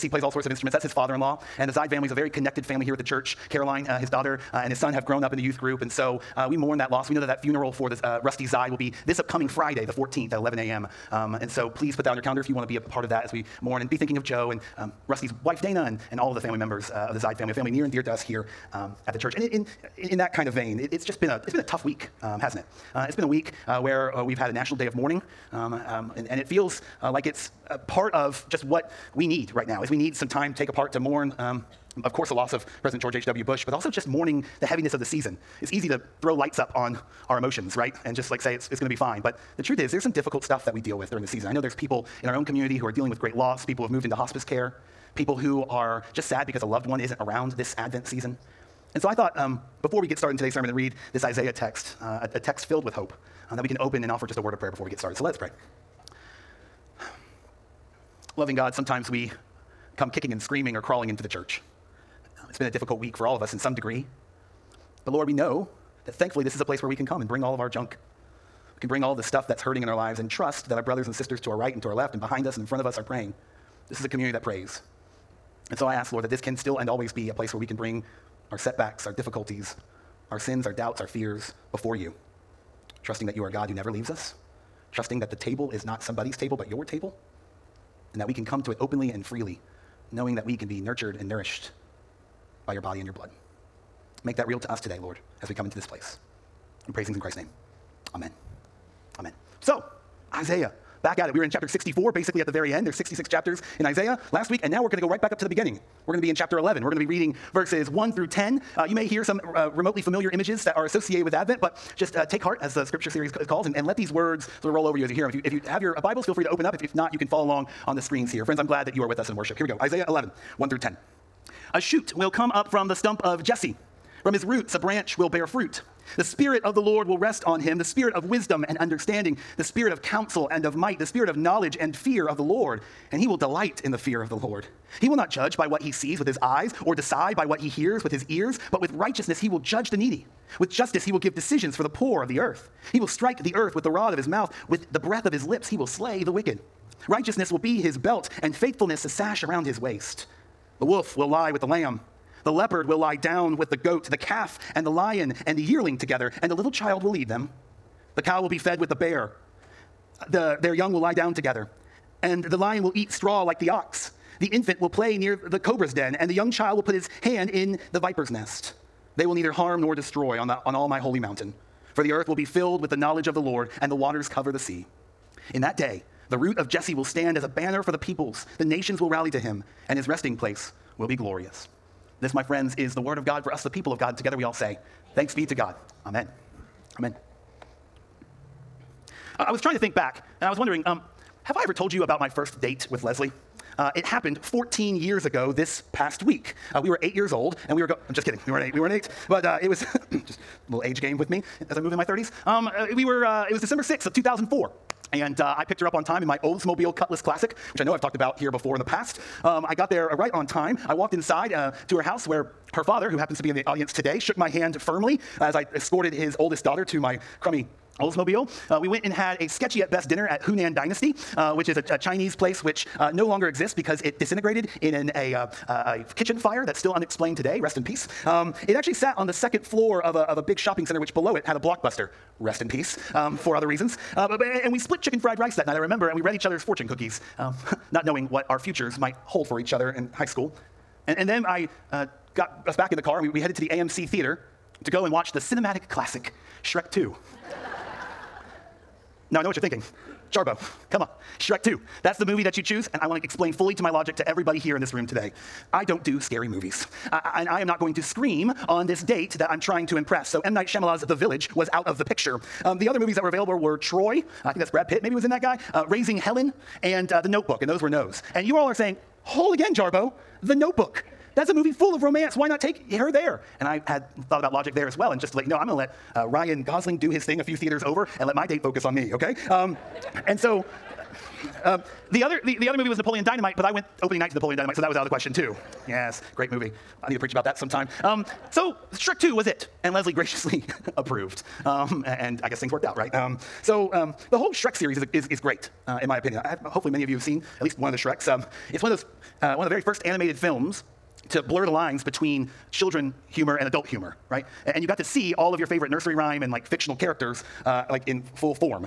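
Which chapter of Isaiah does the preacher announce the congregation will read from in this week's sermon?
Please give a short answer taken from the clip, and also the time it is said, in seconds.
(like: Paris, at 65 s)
11, at 106 s.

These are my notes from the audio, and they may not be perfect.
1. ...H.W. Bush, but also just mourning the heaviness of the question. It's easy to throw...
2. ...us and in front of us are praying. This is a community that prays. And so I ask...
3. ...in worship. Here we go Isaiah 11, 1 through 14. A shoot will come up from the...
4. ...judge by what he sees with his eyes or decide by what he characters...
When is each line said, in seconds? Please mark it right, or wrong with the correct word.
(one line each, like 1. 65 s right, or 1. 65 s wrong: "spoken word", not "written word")
1. 33 s wrong: "season", not "question"
2. 72 s right
3. 119 s wrong: "10", not "14"
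4. 135 s wrong: "hears", not "characters".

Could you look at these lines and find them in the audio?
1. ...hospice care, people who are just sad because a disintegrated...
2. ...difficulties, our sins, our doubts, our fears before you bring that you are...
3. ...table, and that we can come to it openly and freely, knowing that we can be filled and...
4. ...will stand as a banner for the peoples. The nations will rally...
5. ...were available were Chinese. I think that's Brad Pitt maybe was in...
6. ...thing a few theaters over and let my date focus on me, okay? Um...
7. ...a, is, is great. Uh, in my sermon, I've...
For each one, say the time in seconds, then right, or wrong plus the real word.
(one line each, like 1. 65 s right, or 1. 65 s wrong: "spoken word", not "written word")
1. 44 s wrong: "loved", not "disintegrated"
2. 79 s wrong: "trusting", not "bring"
3. 86 s wrong: "nurtured", not "filled"
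4. 176 s right
5. 263 s wrong: "Troy", not "Chinese"
6. 277 s right
7. 295 s wrong: "opinion", not "sermon".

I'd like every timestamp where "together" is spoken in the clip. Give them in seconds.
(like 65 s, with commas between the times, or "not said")
155 s, 161 s, 184 s.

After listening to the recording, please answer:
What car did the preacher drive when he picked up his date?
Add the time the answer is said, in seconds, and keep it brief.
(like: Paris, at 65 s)
Oldsmobile Cutlass Classic, at 206 s.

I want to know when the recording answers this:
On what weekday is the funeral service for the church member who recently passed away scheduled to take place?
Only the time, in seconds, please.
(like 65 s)
9 s.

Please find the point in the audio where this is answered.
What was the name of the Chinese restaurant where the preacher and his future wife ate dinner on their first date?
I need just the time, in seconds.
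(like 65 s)
220 s.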